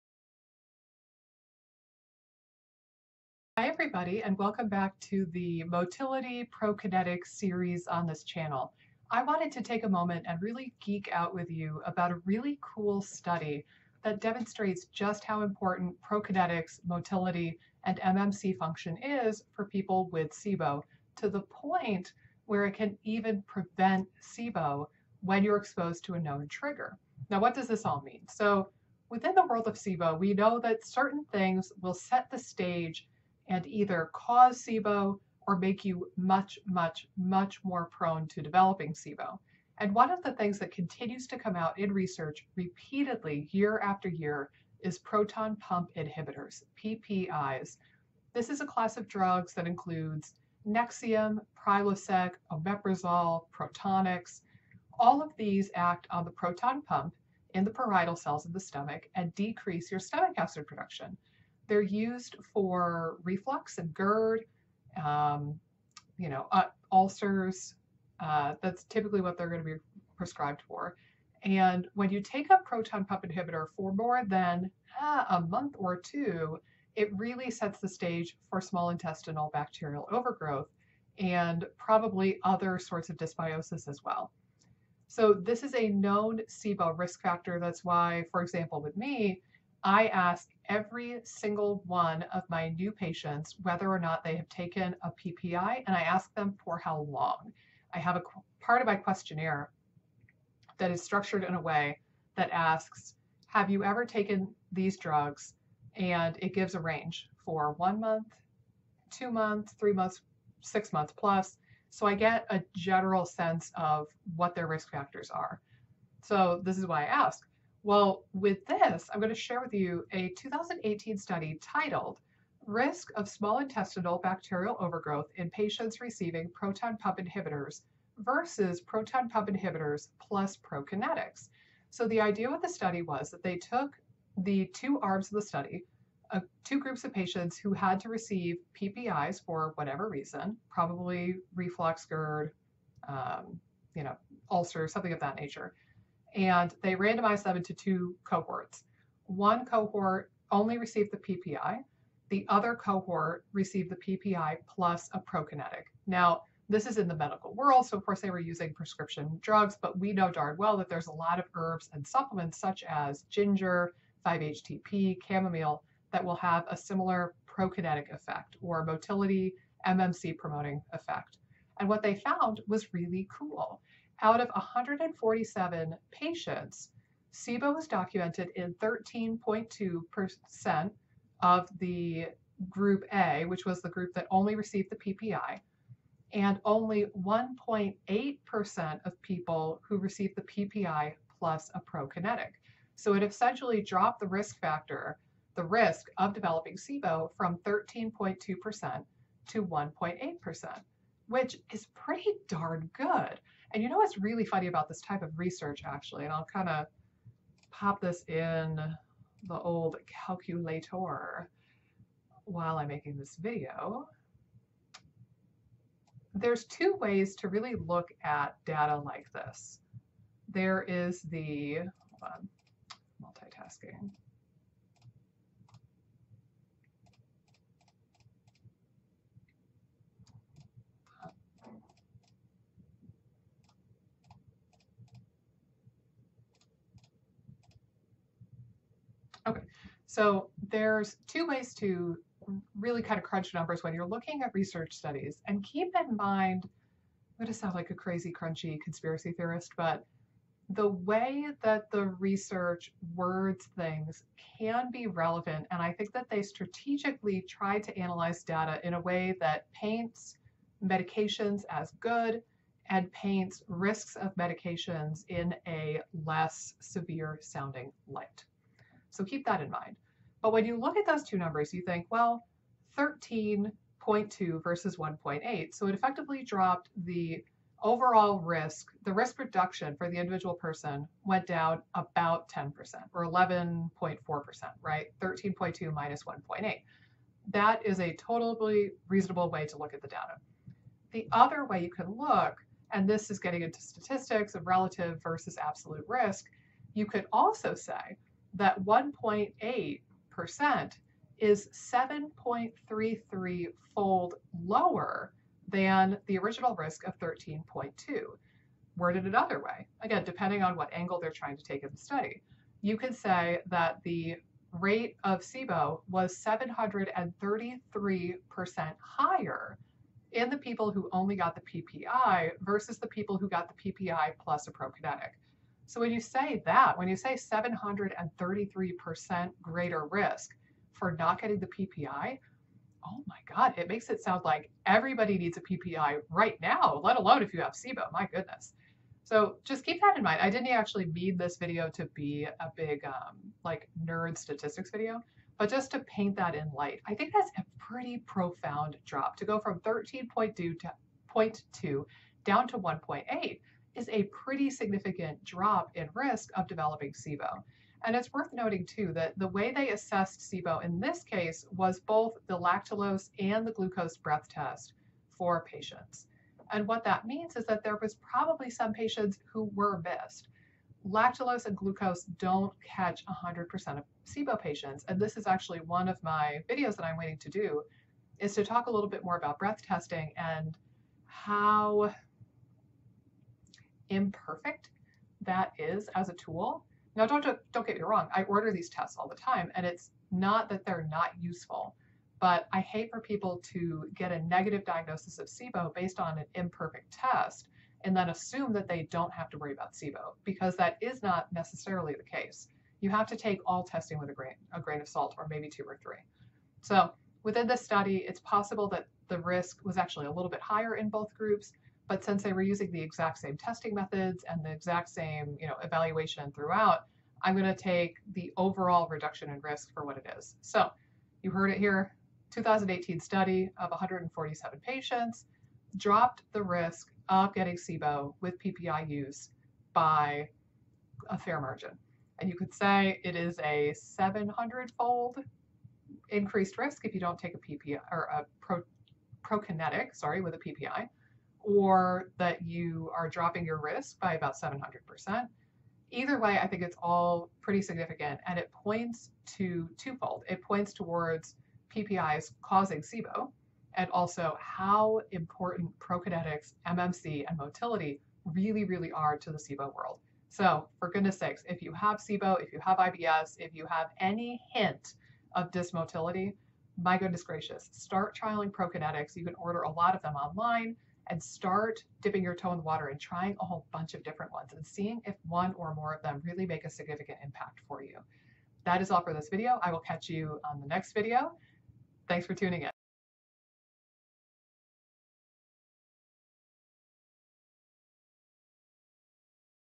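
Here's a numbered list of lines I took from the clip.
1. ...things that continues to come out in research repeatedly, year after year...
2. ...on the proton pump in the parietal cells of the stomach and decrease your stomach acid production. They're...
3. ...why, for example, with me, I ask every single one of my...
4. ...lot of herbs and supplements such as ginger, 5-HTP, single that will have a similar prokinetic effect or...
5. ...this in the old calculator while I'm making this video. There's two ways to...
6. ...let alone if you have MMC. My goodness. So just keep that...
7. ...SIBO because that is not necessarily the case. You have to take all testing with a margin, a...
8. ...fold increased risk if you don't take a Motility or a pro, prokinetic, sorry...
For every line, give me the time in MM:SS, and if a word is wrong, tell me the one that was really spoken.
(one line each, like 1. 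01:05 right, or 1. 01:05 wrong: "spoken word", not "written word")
1. 00:40 right
2. 00:56 right
3. 01:27 right
4. 02:41 wrong: "chamomile", not "single"
5. 03:28 right
6. 05:37 wrong: "SIBO", not "MMC"
7. 06:39 wrong: "grain", not "margin"
8. 07:14 wrong: "PPI", not "Motility".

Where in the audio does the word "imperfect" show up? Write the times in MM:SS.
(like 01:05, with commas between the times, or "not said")
06:24, 06:36.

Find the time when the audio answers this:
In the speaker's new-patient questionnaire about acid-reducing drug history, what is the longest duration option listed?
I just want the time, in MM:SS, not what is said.
01:50.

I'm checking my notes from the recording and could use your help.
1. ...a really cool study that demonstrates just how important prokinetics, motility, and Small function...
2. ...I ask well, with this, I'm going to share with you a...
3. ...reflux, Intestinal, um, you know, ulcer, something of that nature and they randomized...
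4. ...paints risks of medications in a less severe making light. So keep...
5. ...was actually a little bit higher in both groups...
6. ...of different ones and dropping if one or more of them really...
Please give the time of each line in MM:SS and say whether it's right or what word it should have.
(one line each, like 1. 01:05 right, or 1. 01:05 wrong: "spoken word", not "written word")
1. 00:12 wrong: "MMC", not "Small"
2. 01:57 right
3. 02:21 wrong: "GERD", not "Intestinal"
4. 04:23 wrong: "sounding", not "making"
5. 06:49 right
6. 07:54 wrong: "seeing", not "dropping".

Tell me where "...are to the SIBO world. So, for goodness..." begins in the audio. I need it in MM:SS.
07:39.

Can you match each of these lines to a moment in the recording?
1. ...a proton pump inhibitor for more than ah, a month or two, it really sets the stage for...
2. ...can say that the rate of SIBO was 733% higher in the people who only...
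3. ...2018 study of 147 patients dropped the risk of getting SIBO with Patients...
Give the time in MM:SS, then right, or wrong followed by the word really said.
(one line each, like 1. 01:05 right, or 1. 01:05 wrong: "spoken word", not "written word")
1. 01:12 right
2. 05:12 right
3. 07:02 wrong: "PPI", not "Patients".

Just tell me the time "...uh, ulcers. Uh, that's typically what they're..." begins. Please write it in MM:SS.
01:06.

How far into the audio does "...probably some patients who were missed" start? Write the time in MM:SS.
06:08.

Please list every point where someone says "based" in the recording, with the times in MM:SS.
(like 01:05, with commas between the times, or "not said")
06:35.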